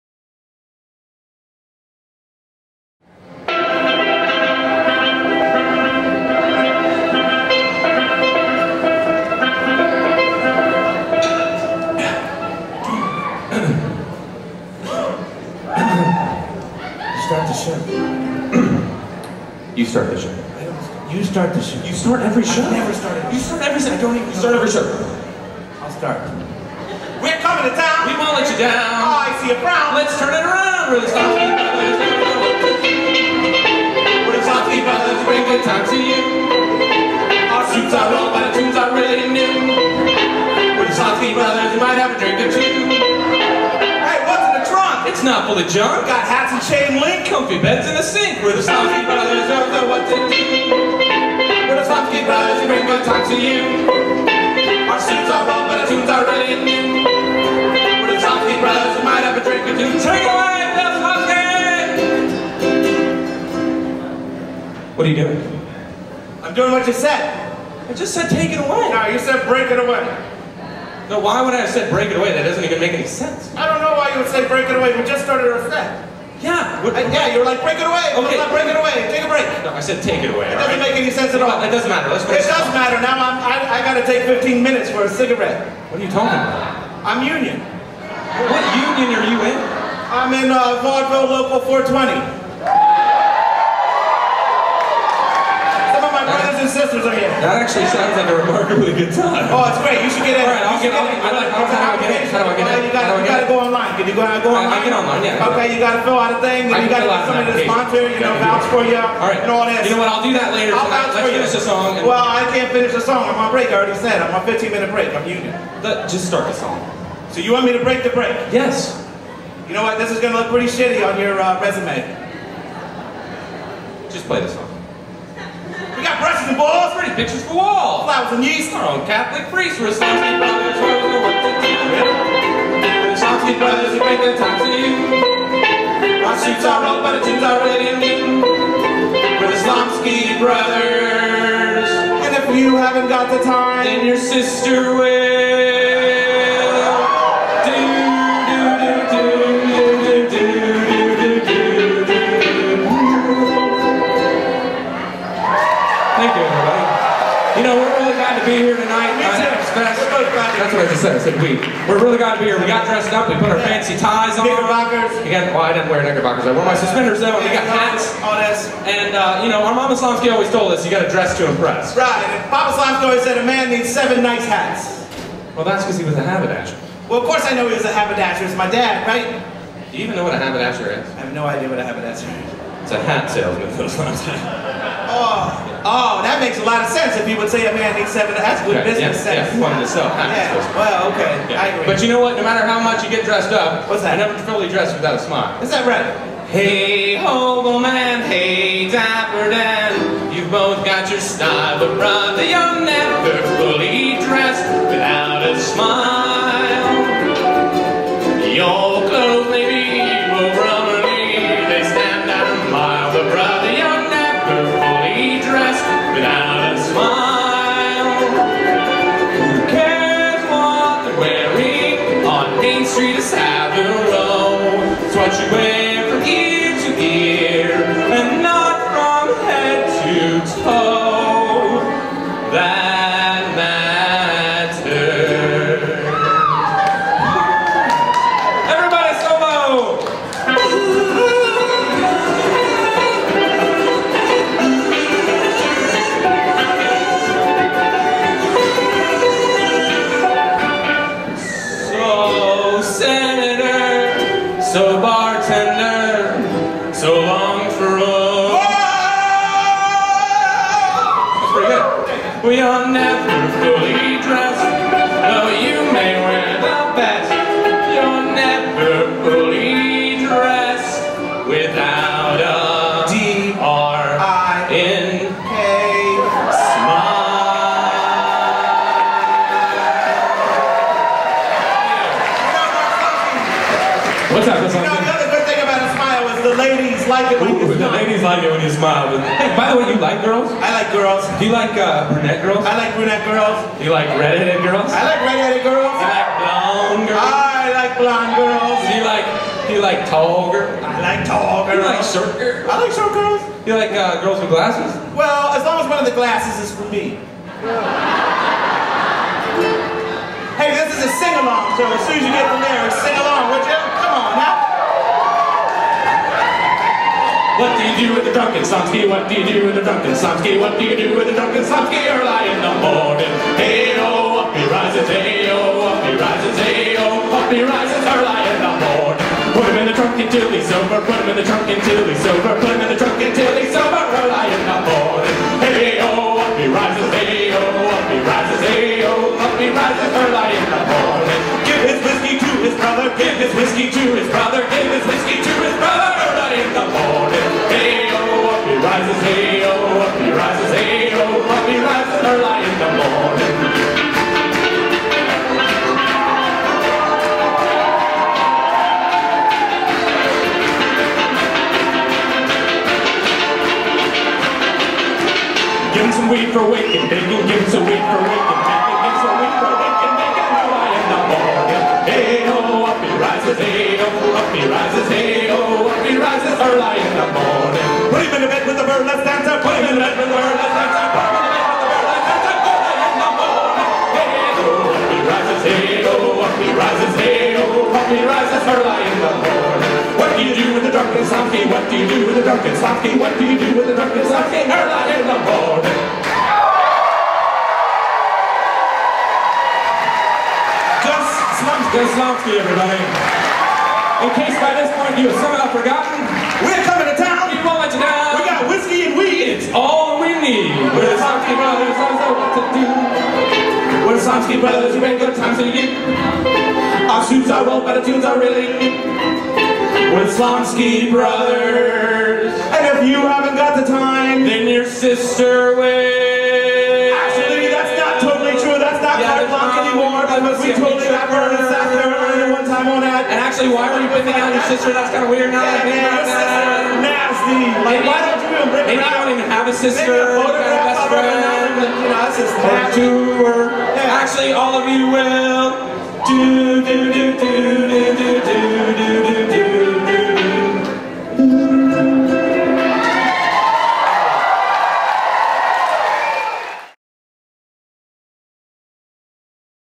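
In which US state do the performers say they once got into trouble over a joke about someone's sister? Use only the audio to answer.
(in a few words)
South Carolina.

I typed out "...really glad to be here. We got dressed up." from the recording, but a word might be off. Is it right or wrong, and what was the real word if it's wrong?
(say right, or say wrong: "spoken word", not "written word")
right.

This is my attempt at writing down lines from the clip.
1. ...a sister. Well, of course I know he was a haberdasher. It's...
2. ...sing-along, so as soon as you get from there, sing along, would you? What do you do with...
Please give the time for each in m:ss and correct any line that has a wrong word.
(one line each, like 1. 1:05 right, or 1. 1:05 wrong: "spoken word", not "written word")
1. 2:56 wrong: "haberdasher", not "sister"
2. 5:11 right.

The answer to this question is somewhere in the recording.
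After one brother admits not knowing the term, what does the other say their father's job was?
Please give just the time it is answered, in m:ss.
3:03.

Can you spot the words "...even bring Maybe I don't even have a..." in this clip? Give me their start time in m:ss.
7:18.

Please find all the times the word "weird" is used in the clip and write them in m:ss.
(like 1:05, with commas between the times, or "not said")
7:15.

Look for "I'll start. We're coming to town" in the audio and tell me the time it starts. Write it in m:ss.
0:25.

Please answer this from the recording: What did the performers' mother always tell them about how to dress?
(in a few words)
Dress to impress.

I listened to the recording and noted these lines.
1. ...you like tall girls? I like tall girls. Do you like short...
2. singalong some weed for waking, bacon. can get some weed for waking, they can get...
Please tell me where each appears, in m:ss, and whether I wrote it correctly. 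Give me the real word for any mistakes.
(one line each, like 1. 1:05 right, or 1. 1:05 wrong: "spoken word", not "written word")
1. 4:59 right
2. 6:06 wrong: "getting", not "singalong".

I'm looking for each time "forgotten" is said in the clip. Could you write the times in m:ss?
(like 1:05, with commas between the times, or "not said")
6:45.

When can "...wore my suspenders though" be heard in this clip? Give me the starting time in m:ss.
2:46.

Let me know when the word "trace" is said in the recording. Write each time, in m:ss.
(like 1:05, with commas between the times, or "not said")
not said.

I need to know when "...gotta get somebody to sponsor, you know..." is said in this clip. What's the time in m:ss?
1:46.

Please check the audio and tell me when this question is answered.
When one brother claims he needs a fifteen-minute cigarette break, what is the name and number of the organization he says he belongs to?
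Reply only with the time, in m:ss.
1:30.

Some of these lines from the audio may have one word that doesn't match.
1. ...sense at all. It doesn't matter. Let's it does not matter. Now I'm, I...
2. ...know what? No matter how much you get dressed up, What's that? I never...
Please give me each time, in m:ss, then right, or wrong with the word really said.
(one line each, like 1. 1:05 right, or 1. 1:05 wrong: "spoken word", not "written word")
1. 1:21 right
2. 3:12 right.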